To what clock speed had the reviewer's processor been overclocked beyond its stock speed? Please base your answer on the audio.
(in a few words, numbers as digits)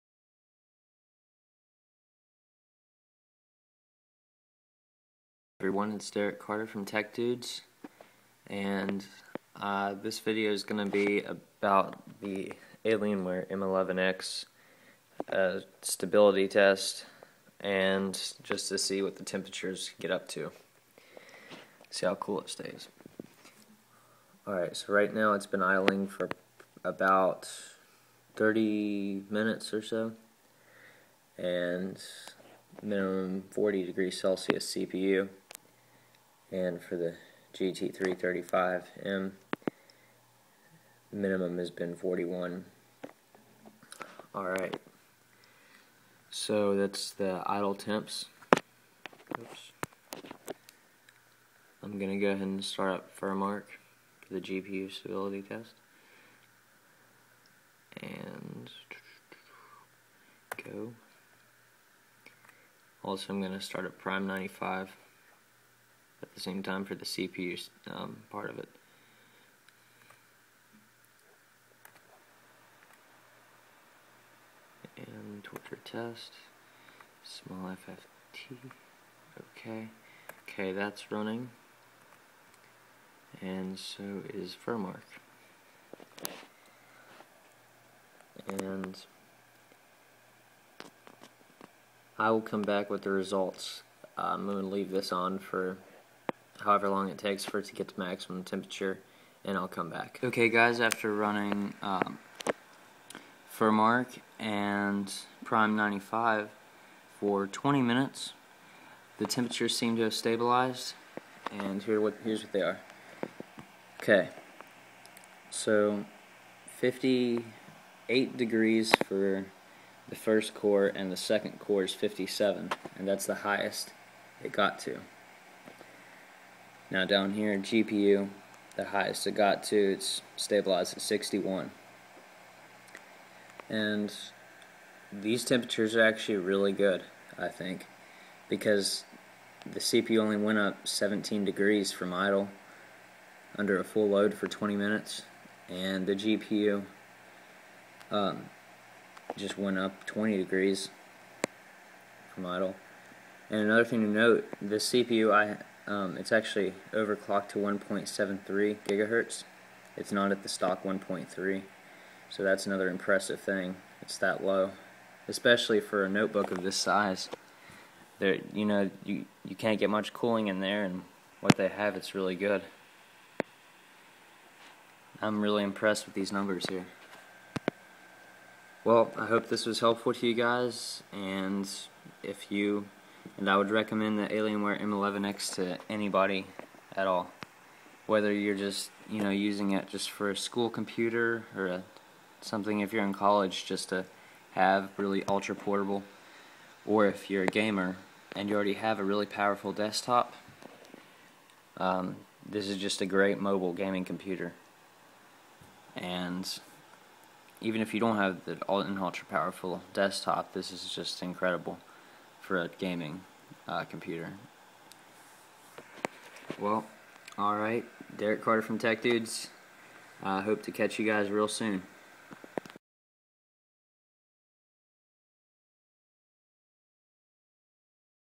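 1.73 gigahertz.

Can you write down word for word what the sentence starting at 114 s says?
Okay, so 58 degrees for the first core, and the second core is 57, and that's the highest it got to.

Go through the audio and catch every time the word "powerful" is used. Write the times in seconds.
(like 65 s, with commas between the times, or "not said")
199 s, 209 s.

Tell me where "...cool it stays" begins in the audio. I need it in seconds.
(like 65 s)
22 s.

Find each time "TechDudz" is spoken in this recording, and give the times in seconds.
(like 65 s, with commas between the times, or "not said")
6 s, 218 s.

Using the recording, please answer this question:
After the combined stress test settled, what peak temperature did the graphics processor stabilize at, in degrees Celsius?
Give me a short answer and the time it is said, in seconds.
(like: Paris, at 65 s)
61, at 131 s.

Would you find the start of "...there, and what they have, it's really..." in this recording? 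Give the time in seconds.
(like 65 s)
170 s.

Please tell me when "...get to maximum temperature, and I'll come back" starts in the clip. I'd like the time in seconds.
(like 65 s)
97 s.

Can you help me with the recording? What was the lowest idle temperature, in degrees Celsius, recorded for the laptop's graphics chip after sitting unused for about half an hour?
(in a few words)
41.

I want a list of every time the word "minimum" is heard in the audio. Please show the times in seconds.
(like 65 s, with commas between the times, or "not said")
32 s, 41 s.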